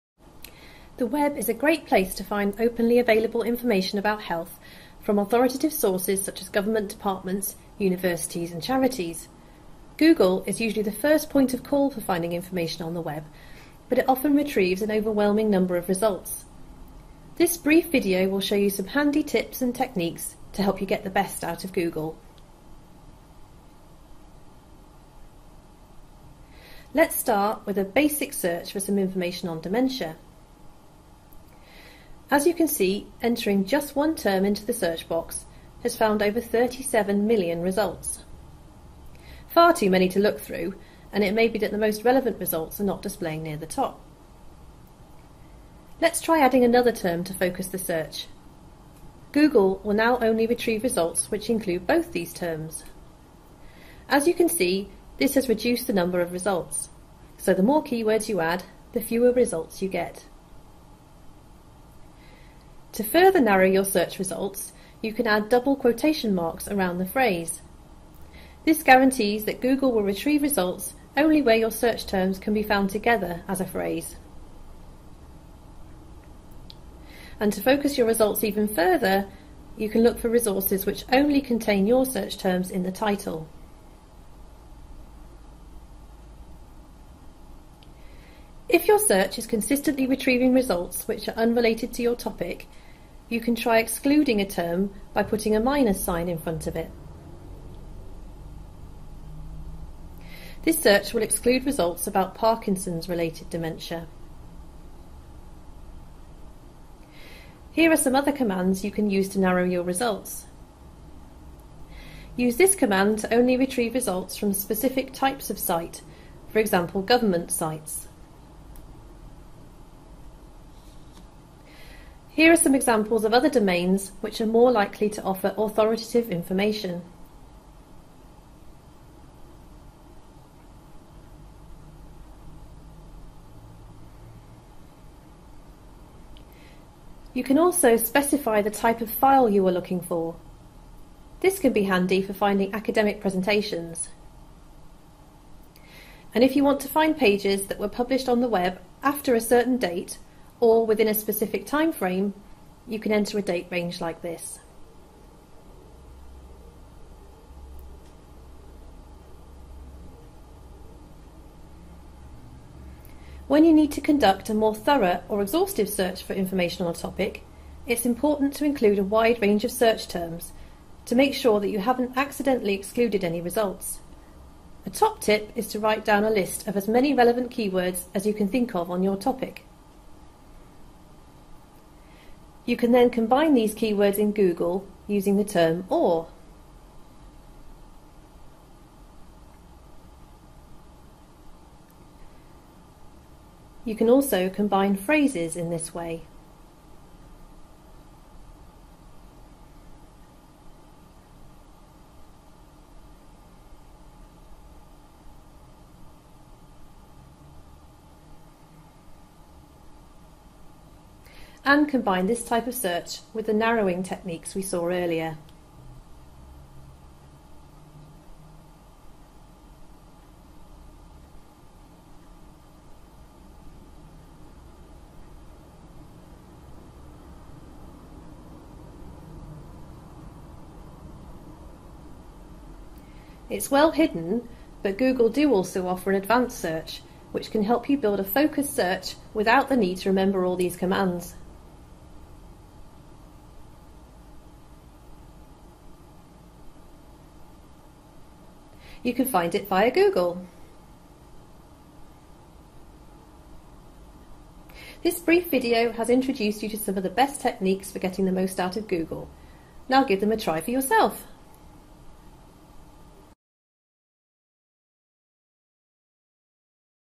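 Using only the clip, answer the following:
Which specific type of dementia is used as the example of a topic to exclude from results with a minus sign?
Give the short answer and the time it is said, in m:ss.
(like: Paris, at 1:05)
Parkinson's related dementia, at 1:42.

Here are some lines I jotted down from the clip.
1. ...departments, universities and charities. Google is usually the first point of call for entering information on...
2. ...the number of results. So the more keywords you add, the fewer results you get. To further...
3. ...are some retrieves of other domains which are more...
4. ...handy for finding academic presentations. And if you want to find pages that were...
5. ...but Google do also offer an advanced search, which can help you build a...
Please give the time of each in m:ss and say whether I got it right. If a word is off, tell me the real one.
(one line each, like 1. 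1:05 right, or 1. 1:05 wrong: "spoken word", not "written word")
1. 0:06 wrong: "finding", not "entering"
2. 0:55 right
3. 2:02 wrong: "examples", not "retrieves"
4. 2:21 right
5. 3:54 right.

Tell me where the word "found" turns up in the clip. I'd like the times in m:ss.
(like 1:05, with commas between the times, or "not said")
0:35, 1:12.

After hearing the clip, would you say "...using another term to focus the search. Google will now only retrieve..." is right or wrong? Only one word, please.
wrong.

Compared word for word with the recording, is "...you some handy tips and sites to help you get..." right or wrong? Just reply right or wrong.
wrong.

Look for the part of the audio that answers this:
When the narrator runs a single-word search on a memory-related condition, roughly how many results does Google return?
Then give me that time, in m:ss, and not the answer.
0:36.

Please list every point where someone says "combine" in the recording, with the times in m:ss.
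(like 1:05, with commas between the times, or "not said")
3:03, 3:14, 3:31.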